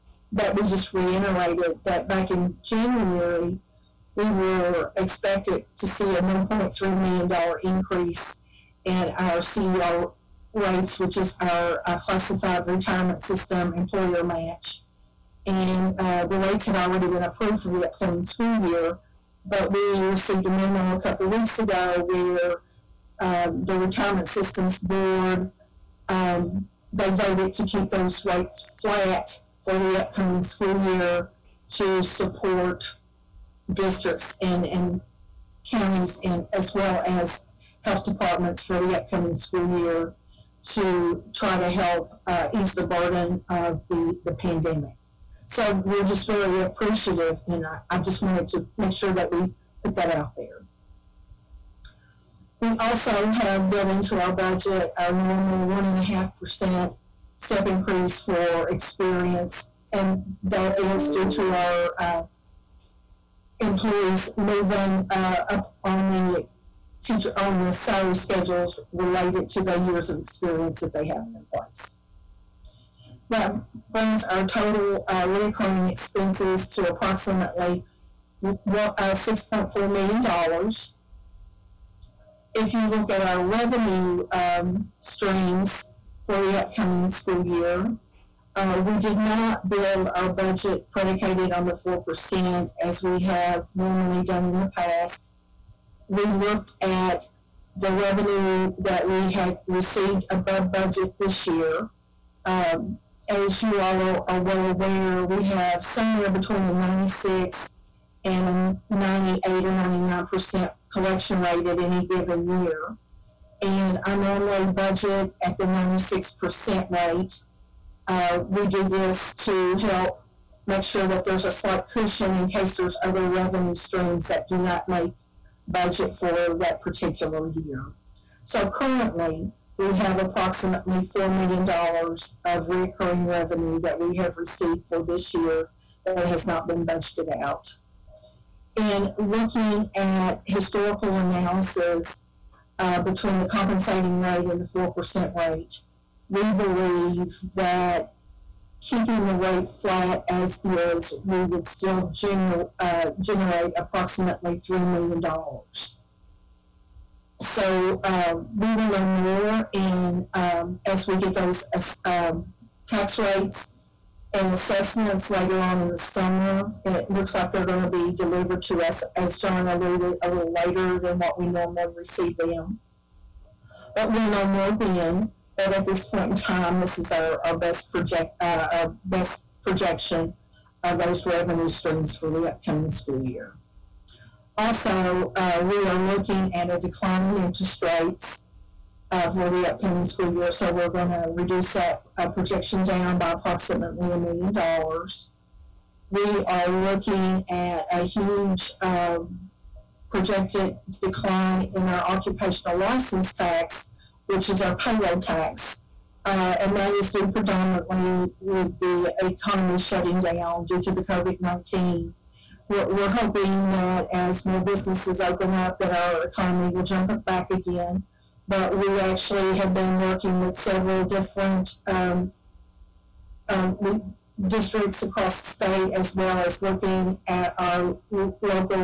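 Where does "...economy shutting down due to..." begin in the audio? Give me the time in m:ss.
3:29.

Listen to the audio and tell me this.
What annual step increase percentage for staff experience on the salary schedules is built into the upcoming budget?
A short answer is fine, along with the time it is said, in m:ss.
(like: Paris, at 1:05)
1.5%, at 0:55.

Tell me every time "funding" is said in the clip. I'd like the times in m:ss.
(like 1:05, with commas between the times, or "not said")
not said.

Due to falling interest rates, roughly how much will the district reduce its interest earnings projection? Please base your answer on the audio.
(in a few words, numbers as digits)
$1 million.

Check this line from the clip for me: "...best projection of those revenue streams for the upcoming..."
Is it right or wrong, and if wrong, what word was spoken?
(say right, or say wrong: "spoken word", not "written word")
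right.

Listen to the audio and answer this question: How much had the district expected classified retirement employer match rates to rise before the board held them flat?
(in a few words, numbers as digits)
$1.3 million.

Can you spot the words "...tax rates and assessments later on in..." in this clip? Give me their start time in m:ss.
2:42.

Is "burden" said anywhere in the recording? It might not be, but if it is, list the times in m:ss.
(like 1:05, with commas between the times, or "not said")
0:42.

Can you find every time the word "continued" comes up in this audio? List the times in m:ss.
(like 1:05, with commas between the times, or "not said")
not said.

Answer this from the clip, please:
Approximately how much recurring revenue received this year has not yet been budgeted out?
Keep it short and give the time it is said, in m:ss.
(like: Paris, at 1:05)
$4 million, at 2:11.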